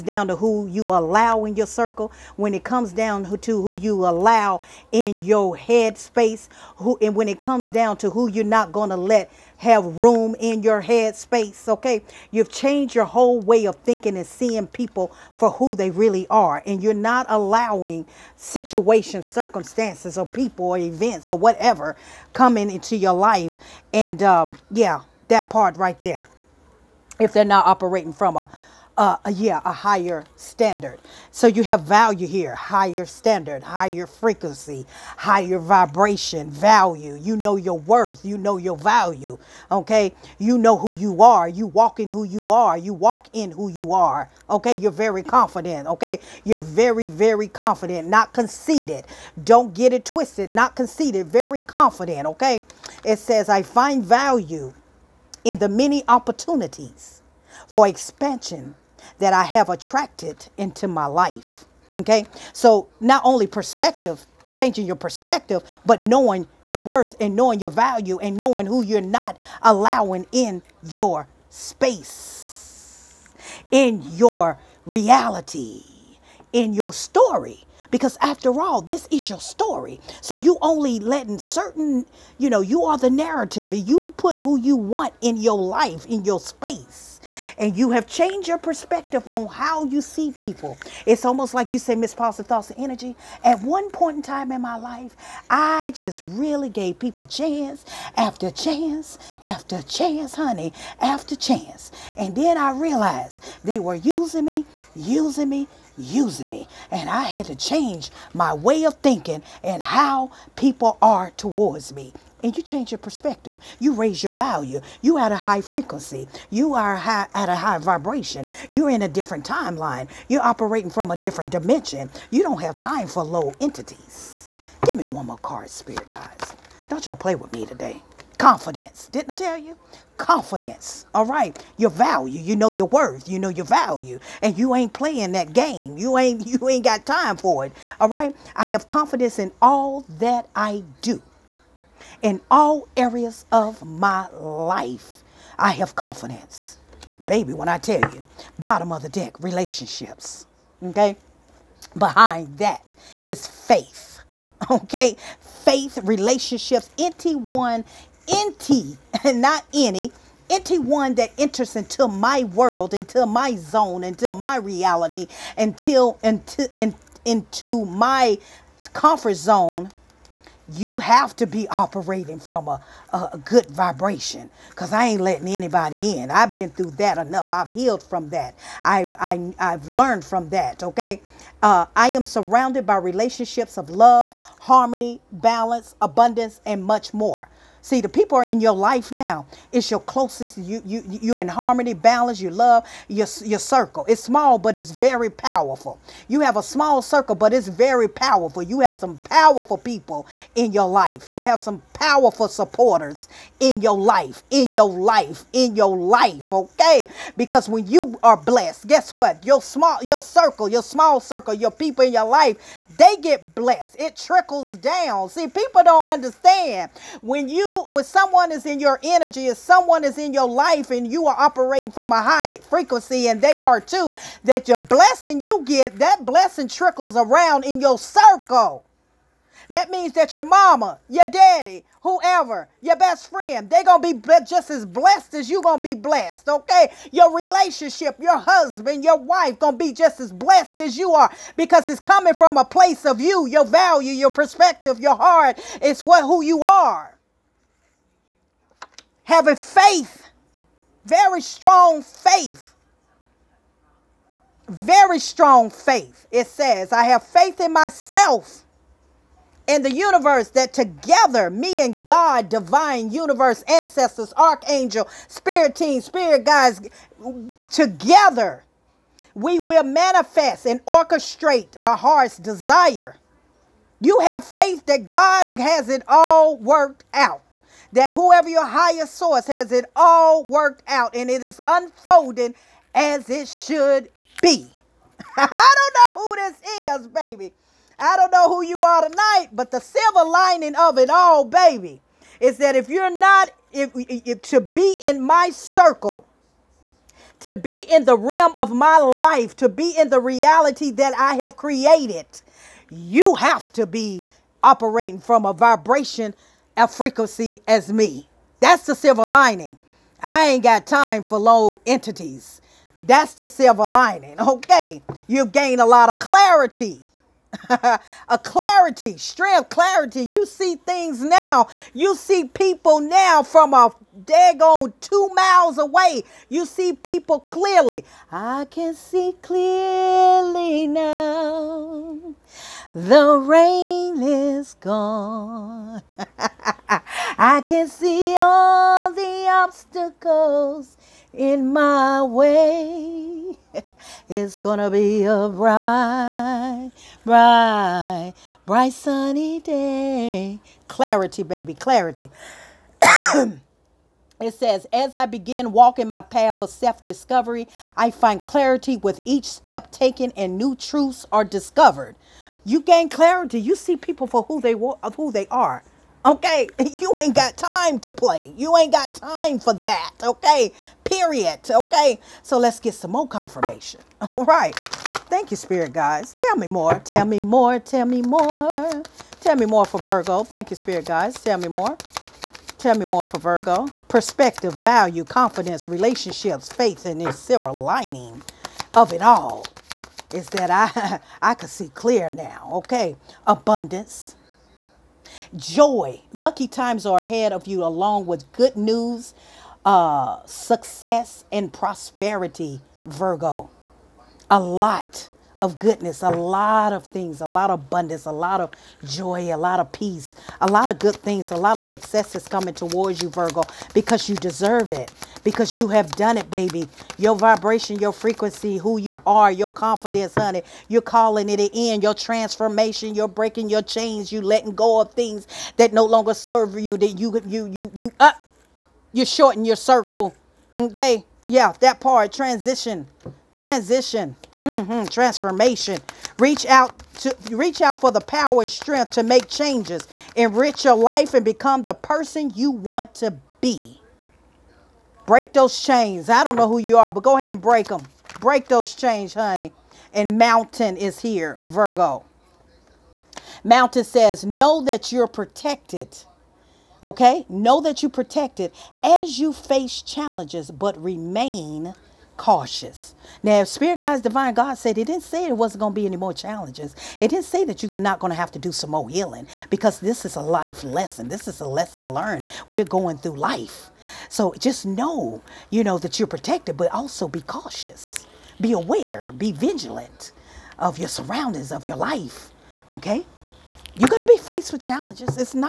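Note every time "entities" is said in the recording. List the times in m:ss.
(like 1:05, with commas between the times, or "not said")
2:03, 5:11.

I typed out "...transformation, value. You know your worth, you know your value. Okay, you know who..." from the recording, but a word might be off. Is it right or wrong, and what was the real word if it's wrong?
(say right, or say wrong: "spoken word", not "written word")
wrong: "vibration", not "transformation".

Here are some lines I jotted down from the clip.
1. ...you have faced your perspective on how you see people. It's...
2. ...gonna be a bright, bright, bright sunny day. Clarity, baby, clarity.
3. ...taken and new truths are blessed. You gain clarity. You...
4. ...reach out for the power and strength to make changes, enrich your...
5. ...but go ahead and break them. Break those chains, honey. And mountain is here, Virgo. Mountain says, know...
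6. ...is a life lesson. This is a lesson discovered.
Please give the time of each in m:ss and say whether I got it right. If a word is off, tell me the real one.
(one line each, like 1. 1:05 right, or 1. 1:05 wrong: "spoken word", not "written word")
1. 1:27 wrong: "changed", not "faced"
2. 5:44 right
3. 5:59 wrong: "discovered", not "blessed"
4. 7:17 right
5. 7:27 right
6. 7:50 wrong: "learned", not "discovered".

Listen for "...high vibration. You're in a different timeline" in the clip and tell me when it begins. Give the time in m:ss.
1:57.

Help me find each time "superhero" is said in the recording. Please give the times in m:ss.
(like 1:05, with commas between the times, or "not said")
not said.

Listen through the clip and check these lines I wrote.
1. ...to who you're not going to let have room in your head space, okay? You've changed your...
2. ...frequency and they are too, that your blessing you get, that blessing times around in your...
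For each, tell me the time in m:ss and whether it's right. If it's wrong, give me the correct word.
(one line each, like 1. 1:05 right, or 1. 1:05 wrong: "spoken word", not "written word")
1. 0:07 right
2. 3:42 wrong: "trickles", not "times".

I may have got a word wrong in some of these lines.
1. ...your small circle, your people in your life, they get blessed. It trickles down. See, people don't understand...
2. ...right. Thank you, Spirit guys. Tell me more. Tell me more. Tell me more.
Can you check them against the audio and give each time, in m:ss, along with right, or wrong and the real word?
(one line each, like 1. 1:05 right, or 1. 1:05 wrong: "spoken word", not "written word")
1. 3:30 right
2. 6:14 right.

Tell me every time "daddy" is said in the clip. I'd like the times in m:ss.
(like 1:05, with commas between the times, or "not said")
3:51.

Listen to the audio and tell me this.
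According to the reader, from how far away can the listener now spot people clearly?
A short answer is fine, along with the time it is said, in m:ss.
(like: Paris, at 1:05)
Two miles, at 5:25.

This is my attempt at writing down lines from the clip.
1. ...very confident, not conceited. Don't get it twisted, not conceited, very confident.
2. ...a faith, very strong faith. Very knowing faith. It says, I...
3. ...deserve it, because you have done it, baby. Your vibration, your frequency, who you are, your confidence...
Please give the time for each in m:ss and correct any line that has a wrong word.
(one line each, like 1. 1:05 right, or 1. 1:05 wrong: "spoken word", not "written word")
1. 0:47 right
2. 4:09 wrong: "strong", not "knowing"
3. 6:54 right.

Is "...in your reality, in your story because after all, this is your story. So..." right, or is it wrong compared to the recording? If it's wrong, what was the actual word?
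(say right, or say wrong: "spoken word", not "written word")
right.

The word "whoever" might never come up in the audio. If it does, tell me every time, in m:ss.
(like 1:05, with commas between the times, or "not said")
3:52, 4:38.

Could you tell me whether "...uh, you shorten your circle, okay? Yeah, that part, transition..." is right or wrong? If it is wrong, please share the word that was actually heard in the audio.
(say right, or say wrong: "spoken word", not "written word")
right.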